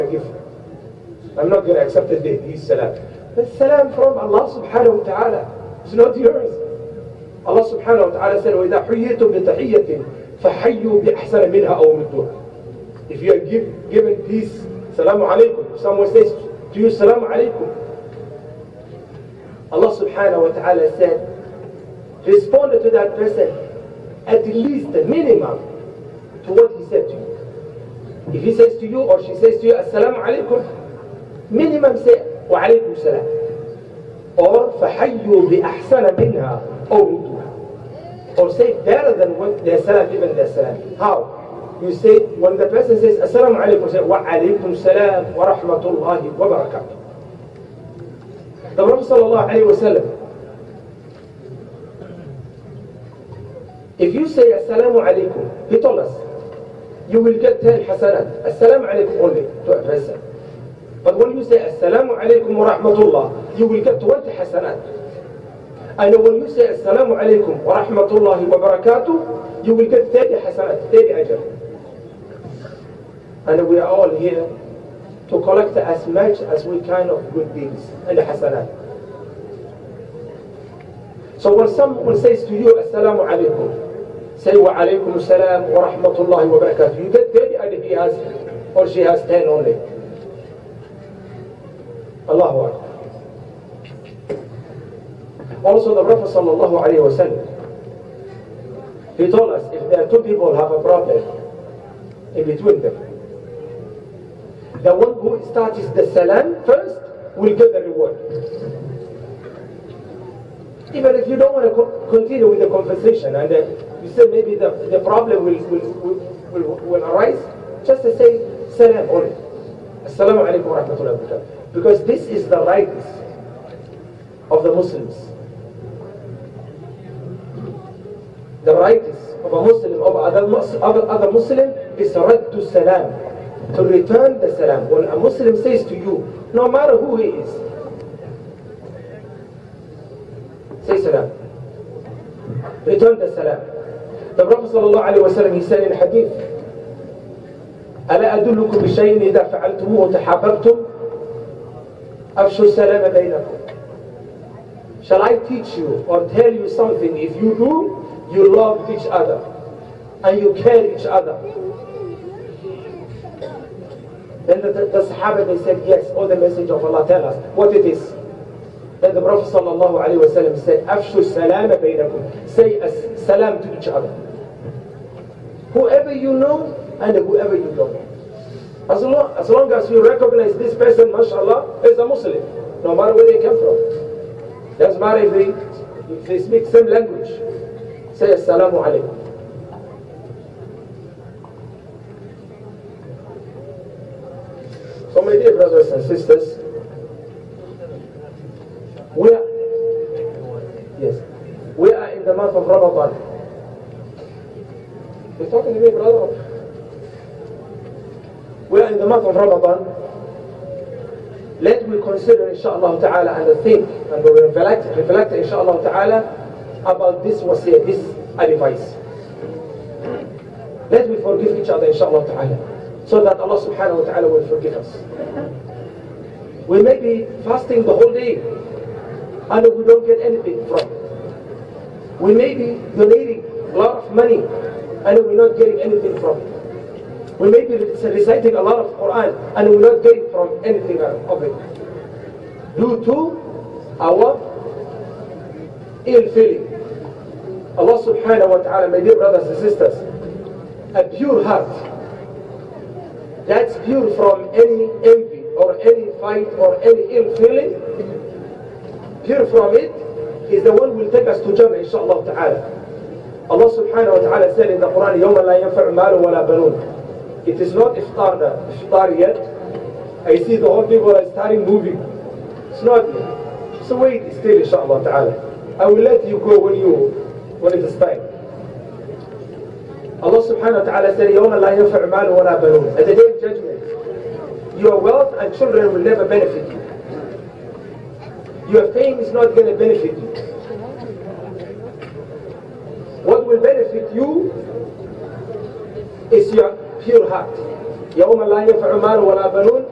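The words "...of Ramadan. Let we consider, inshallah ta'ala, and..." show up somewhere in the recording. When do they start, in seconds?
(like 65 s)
209 s.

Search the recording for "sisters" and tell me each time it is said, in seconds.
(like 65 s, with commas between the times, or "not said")
196 s, 249 s.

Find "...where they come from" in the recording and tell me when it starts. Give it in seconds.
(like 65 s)
183 s.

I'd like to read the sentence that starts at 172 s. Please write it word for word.
Say as salam to each other.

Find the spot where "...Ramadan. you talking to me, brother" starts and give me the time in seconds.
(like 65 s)
202 s.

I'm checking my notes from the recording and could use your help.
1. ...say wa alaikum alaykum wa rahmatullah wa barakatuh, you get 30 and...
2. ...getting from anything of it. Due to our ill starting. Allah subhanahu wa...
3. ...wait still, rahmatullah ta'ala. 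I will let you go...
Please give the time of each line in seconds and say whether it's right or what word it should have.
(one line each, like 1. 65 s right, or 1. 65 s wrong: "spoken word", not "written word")
1. 84 s right
2. 240 s wrong: "feeling", not "starting"
3. 273 s wrong: "inshallah", not "rahmatullah".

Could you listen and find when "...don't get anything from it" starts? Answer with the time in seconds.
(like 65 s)
229 s.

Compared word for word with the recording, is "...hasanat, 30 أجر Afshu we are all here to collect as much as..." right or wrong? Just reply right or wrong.
wrong.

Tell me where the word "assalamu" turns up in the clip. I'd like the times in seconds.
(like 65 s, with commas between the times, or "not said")
29 s, 120 s, 188 s.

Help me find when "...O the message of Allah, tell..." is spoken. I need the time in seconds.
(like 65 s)
166 s.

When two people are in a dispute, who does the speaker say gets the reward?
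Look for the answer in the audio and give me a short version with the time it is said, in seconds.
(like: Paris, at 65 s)
The one who starts the salam first, at 105 s.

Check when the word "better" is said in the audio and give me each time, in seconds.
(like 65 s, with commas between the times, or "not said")
38 s.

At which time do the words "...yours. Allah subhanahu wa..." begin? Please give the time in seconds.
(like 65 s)
6 s.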